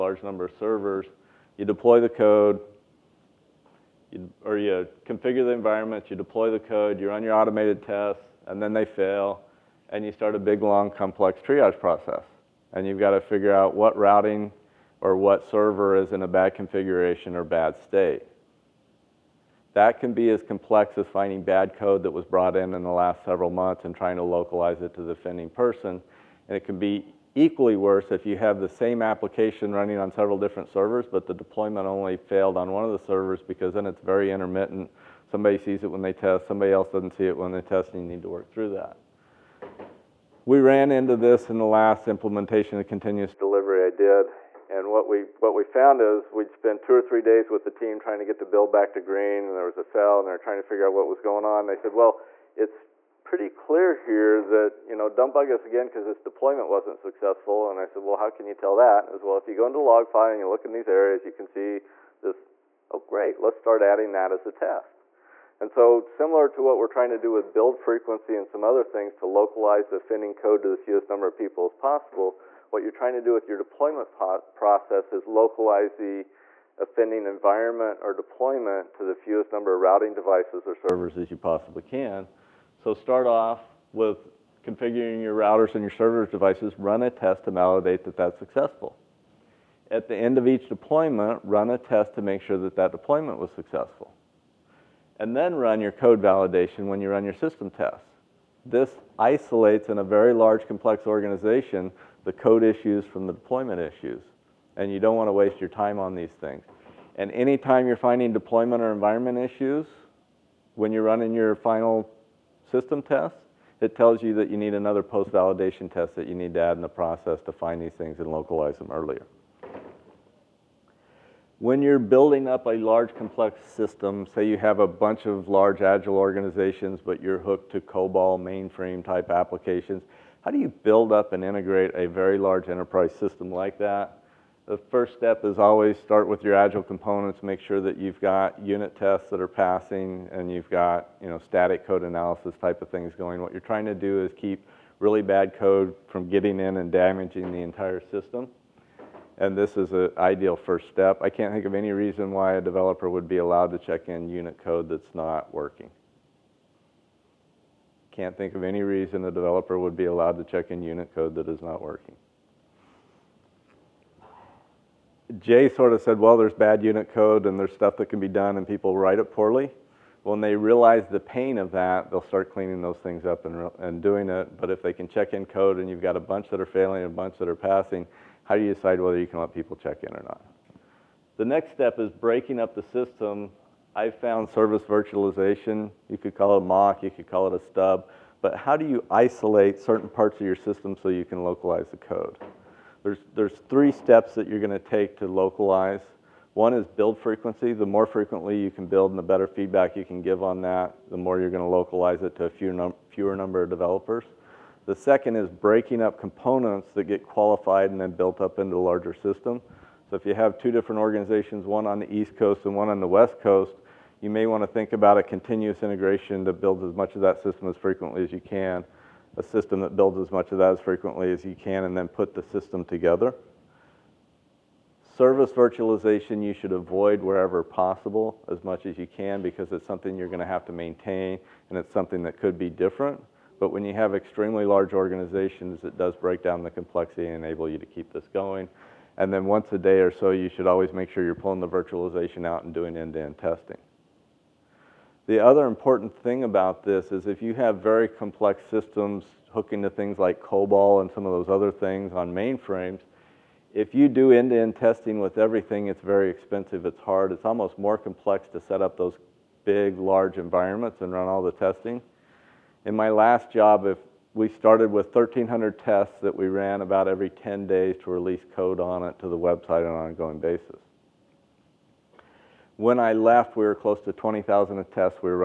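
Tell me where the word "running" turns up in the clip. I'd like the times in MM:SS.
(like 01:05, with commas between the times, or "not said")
00:29, 01:51.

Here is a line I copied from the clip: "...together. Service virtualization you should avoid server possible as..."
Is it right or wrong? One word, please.
wrong.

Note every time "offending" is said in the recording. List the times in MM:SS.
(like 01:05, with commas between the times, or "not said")
00:25, 01:16.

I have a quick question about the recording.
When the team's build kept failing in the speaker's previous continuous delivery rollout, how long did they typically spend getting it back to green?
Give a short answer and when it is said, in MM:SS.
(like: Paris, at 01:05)
2 or 3 days, at 00:46.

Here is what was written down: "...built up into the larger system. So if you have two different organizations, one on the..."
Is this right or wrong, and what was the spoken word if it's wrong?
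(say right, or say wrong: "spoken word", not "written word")
right.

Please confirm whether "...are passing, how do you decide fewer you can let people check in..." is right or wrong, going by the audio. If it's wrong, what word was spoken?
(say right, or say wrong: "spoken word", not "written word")
wrong: "whether", not "fewer".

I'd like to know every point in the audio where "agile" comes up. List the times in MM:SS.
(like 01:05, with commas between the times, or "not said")
02:05, 02:16.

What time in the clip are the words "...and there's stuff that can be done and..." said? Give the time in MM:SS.
02:47.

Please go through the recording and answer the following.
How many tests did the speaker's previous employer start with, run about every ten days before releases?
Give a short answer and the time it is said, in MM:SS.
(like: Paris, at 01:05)
1,300, at 04:25.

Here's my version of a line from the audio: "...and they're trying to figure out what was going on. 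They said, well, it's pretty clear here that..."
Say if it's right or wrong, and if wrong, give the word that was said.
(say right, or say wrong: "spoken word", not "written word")
right.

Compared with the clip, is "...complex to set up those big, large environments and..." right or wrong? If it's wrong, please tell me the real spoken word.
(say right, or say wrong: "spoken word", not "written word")
right.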